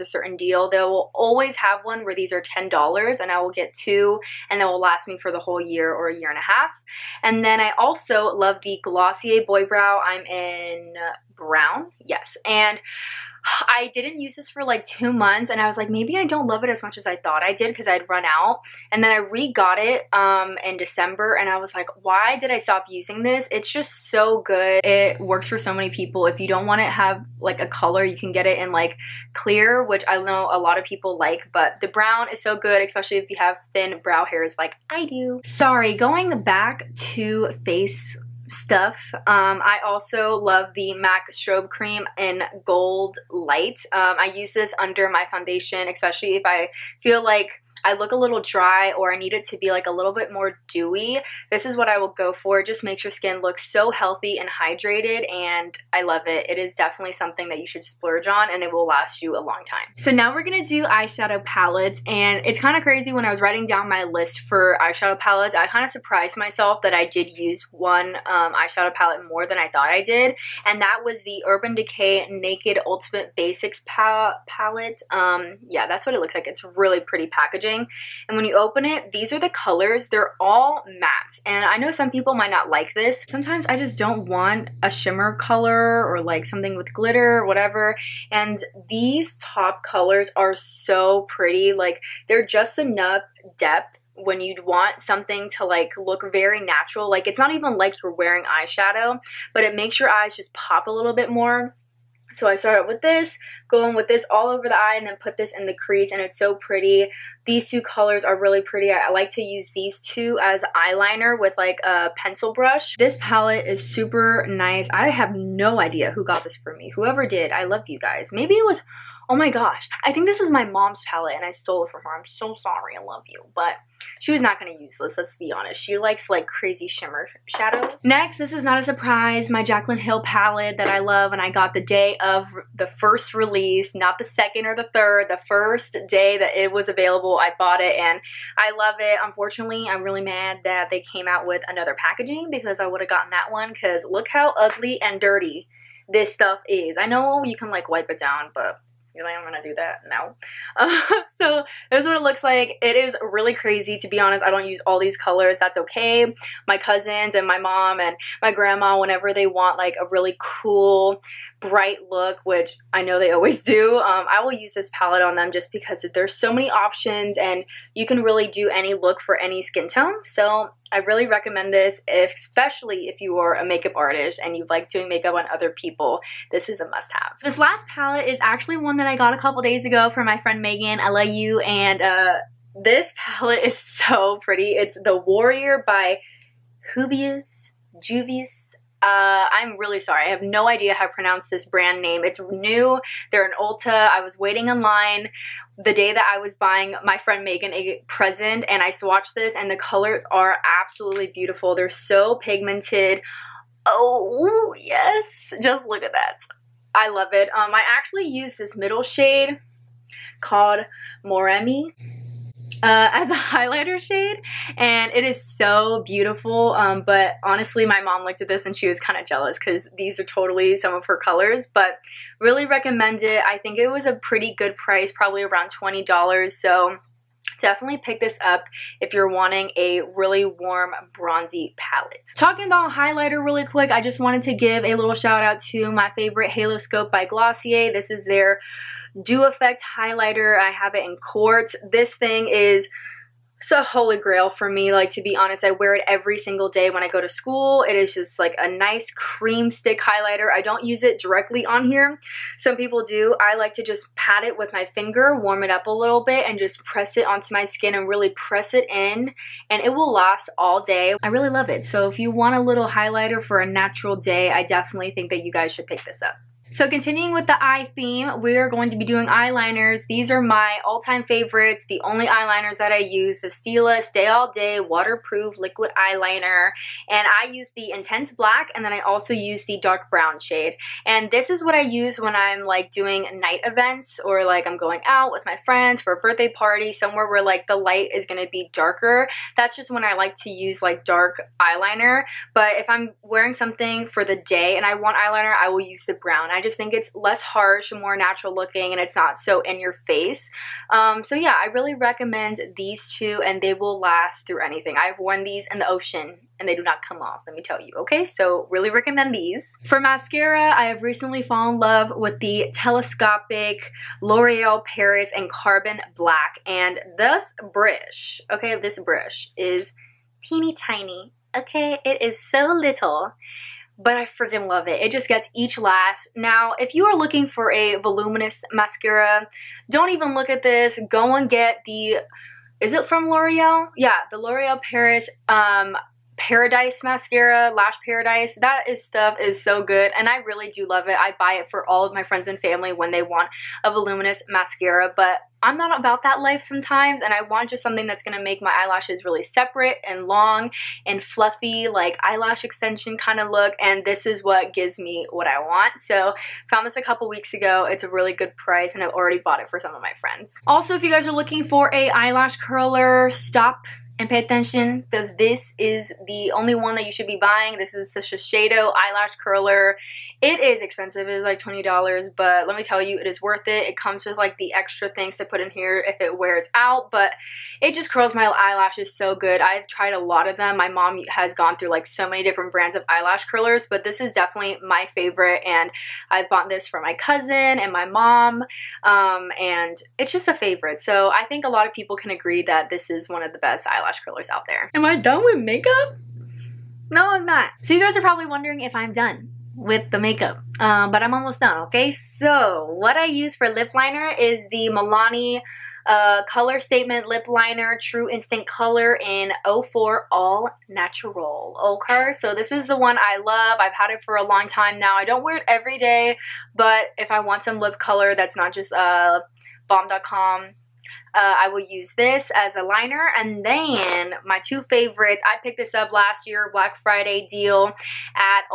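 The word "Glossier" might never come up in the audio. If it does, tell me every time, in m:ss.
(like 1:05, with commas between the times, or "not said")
0:08, 3:57.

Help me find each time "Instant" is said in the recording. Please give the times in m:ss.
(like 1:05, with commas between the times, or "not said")
6:48.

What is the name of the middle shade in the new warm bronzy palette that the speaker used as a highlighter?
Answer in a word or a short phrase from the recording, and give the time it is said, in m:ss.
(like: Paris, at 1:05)
Moremi, at 3:31.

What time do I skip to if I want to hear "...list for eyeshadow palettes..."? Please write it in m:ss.
1:04.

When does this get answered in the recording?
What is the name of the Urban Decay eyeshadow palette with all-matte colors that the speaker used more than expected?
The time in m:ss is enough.
1:12.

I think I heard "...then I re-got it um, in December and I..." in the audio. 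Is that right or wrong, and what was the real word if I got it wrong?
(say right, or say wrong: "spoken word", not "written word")
right.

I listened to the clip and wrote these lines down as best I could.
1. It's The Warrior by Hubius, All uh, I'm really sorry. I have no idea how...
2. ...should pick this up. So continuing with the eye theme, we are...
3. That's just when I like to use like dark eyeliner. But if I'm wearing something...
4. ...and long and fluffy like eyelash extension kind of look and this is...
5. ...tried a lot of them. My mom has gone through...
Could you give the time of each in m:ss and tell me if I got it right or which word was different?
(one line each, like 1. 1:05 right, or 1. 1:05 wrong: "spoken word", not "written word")
1. 3:04 wrong: "Juvius", not "All"
2. 4:25 right
3. 4:49 right
4. 5:50 right
5. 6:19 right.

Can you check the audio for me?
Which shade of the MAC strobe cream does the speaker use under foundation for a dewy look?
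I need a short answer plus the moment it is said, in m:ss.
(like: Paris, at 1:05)
Gold light, at 0:42.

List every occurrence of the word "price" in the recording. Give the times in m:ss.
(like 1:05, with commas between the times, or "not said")
3:44, 5:58.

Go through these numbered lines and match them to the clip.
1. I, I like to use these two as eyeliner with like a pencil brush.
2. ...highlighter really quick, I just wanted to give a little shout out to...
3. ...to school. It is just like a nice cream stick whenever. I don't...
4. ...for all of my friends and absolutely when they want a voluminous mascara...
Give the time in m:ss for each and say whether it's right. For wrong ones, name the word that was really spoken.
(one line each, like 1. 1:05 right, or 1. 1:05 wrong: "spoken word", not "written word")
1. 1:48 right
2. 3:52 right
3. 4:07 wrong: "highlighter", not "whenever"
4. 5:41 wrong: "family", not "absolutely".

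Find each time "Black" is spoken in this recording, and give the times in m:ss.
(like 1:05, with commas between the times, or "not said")
4:38, 5:16, 7:06.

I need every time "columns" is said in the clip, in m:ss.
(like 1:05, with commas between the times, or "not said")
not said.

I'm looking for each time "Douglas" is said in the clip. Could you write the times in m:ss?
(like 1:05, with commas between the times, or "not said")
not said.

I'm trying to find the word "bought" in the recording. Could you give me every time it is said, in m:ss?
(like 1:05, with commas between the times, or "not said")
2:17, 5:59, 6:26.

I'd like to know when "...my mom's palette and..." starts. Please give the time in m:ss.
2:00.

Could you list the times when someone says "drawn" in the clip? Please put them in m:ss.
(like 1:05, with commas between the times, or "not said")
not said.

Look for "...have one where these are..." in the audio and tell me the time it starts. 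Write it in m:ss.
0:01.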